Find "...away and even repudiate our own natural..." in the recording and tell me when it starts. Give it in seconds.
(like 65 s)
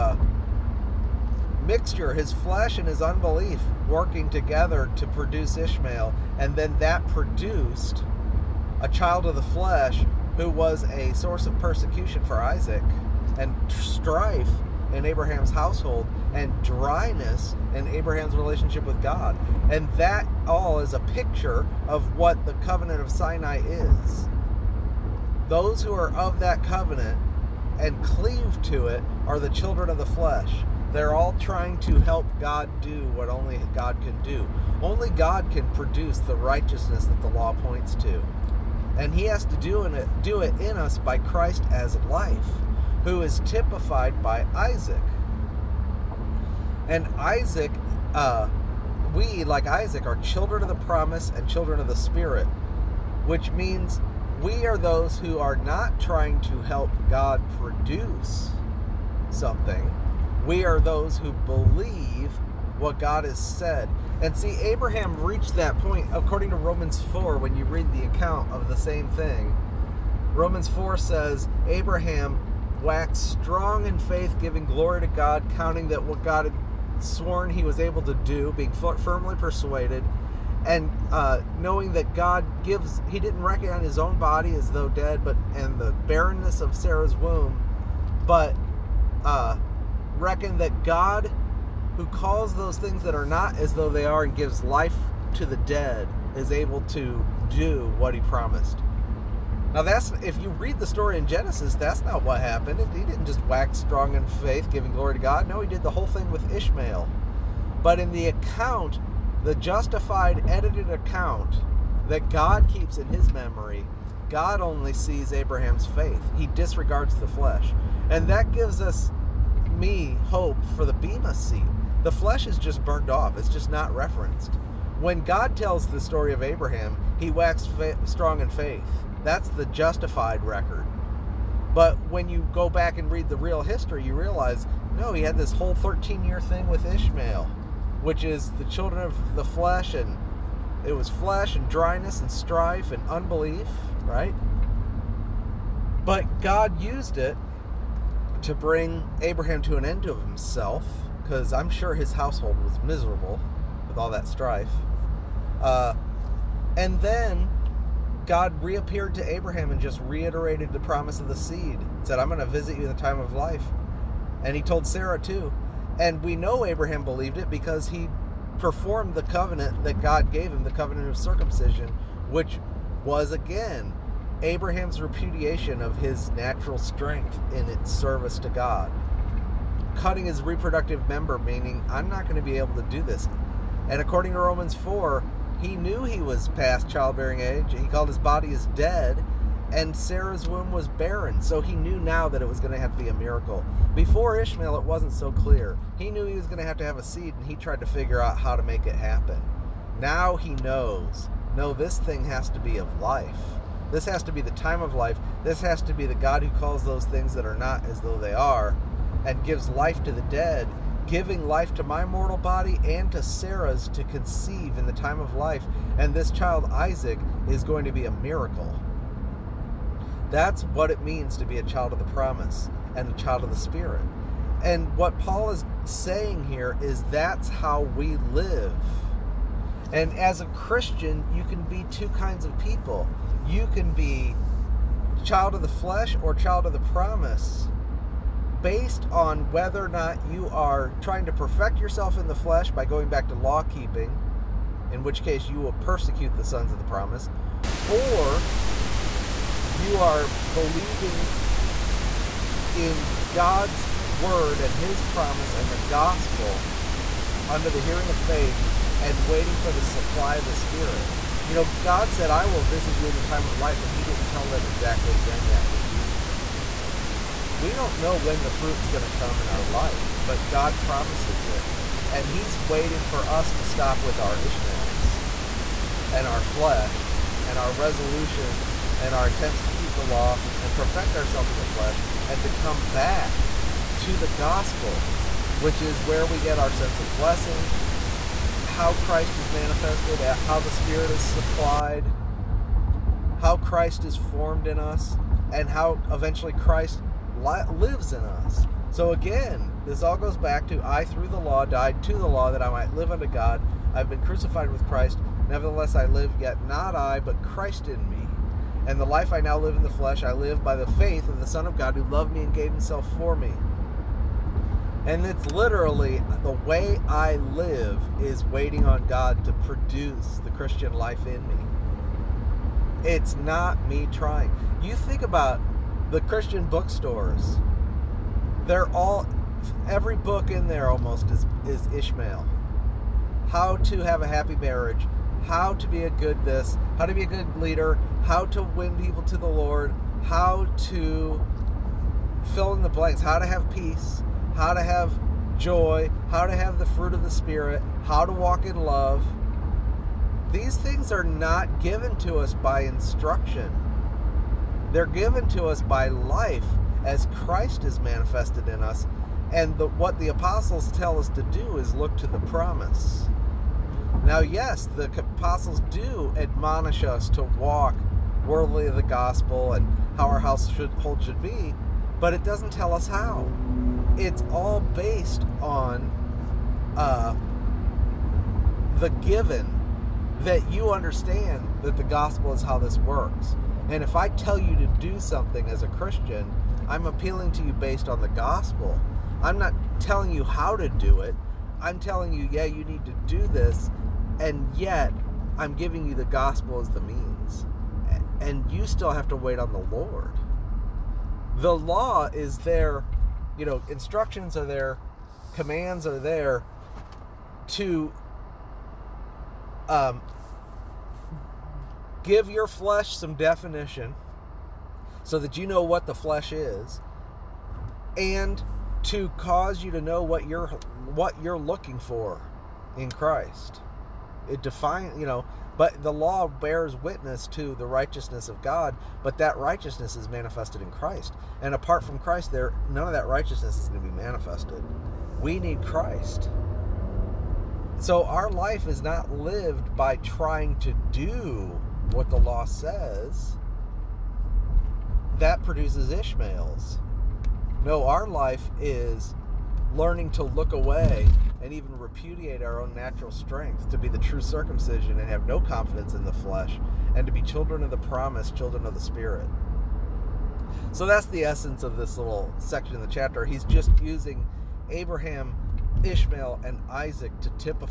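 450 s.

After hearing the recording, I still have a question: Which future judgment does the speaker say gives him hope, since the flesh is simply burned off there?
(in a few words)
the Bema seat.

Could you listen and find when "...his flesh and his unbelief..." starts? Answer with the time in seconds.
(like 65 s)
2 s.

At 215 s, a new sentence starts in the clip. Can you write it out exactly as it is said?
And this child, Isaac, is going to be a miracle.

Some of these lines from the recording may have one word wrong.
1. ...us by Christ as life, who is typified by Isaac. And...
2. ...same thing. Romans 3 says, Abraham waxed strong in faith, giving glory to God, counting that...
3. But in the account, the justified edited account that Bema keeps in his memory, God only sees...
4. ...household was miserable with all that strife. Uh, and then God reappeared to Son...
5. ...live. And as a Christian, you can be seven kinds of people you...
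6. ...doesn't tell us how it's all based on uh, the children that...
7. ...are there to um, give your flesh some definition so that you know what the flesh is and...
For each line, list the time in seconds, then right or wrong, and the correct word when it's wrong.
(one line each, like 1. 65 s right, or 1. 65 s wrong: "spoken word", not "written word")
1. 40 s right
2. 68 s wrong: "4", not "3"
3. 107 s wrong: "God", not "Bema"
4. 152 s wrong: "Abraham", not "Son"
5. 228 s wrong: "two", not "seven"
6. 372 s wrong: "given", not "children"
7. 406 s right.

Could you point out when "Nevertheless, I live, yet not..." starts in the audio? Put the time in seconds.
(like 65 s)
305 s.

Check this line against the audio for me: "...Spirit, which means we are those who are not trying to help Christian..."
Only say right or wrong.
wrong.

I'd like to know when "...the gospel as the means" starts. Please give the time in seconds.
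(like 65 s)
396 s.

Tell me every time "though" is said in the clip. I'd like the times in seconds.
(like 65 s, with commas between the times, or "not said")
84 s, 93 s, 208 s.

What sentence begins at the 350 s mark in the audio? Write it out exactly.
These things are not given to us by instruction, they're given to us by life as Christ is manifested in us.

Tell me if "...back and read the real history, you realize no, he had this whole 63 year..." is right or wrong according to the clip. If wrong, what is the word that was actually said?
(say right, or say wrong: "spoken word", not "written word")
wrong: "13", not "63".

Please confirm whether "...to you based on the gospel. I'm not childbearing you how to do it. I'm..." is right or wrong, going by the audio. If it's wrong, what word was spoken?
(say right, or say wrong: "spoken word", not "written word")
wrong: "telling", not "childbearing".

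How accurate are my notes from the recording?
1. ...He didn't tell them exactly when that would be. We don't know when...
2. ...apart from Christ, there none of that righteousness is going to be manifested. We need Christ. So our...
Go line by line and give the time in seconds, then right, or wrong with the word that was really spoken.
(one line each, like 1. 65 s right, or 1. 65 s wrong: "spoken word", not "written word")
1. 263 s right
2. 431 s right.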